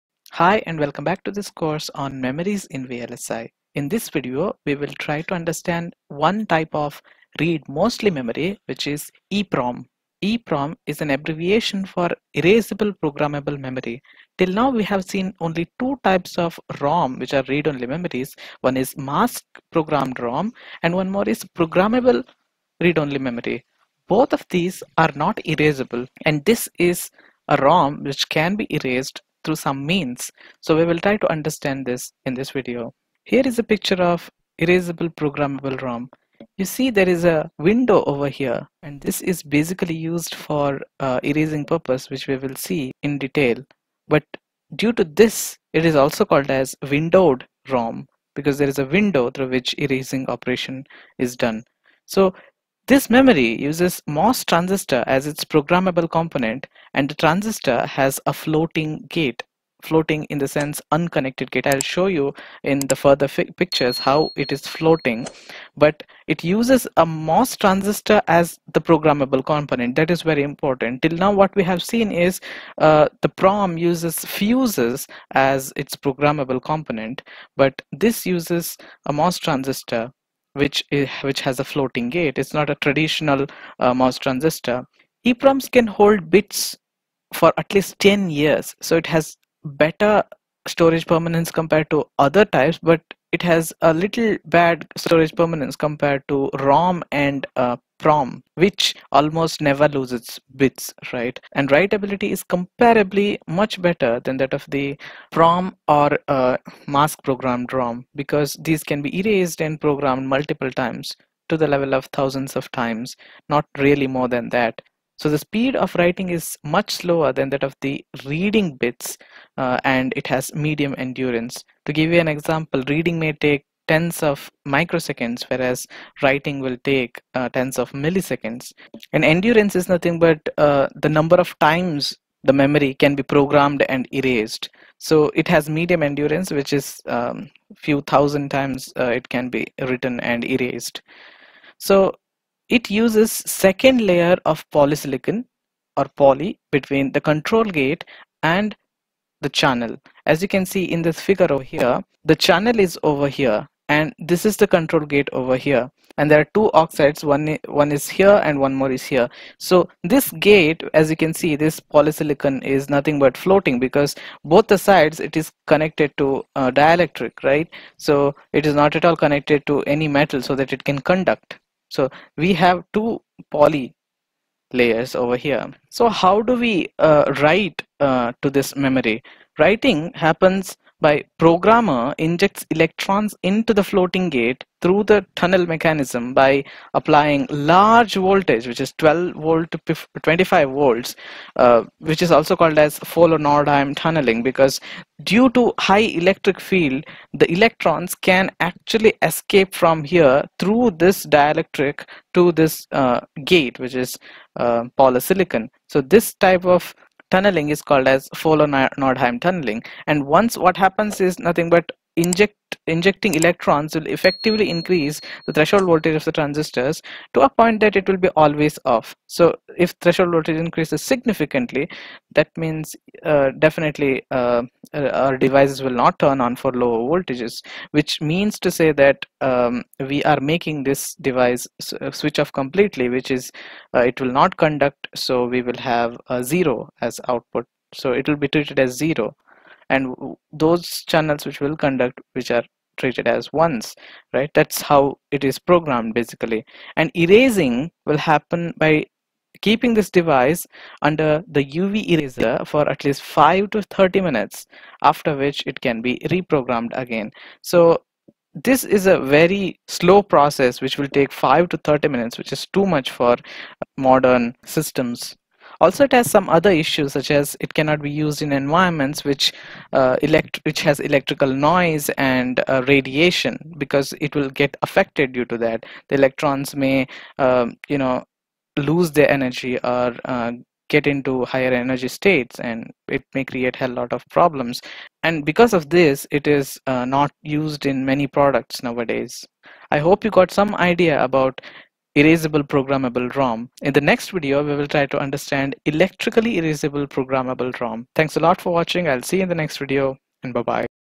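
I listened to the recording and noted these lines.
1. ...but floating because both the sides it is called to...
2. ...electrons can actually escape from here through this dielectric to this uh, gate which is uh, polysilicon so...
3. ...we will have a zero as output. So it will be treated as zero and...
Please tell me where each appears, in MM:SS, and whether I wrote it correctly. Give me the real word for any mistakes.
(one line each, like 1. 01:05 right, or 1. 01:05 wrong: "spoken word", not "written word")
1. 02:43 wrong: "connected", not "called"
2. 03:17 right
3. 03:55 right.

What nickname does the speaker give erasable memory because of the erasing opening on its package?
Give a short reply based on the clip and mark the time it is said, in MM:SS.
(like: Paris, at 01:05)
Windowed ROM, at 00:46.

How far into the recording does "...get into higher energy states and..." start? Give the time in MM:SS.
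04:40.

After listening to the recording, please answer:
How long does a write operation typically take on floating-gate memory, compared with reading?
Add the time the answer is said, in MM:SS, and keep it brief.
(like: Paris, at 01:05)
Tens of milliseconds, at 02:07.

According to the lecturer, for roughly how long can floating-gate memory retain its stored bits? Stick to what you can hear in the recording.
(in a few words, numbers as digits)
At least 10 years.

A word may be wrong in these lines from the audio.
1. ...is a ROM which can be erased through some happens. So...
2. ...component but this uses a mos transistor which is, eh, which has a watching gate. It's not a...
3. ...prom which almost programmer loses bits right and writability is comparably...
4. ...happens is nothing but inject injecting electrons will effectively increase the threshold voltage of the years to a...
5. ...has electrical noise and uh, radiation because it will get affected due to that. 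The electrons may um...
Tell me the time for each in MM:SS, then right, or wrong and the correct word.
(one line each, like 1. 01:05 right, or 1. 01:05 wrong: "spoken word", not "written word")
1. 00:26 wrong: "means", not "happens"
2. 01:16 wrong: "floating", not "watching"
3. 01:38 wrong: "never", not "programmer"
4. 03:30 wrong: "transistors", not "years"
5. 04:30 right.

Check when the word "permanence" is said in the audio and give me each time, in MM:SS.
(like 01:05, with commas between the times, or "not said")
01:31, 01:35.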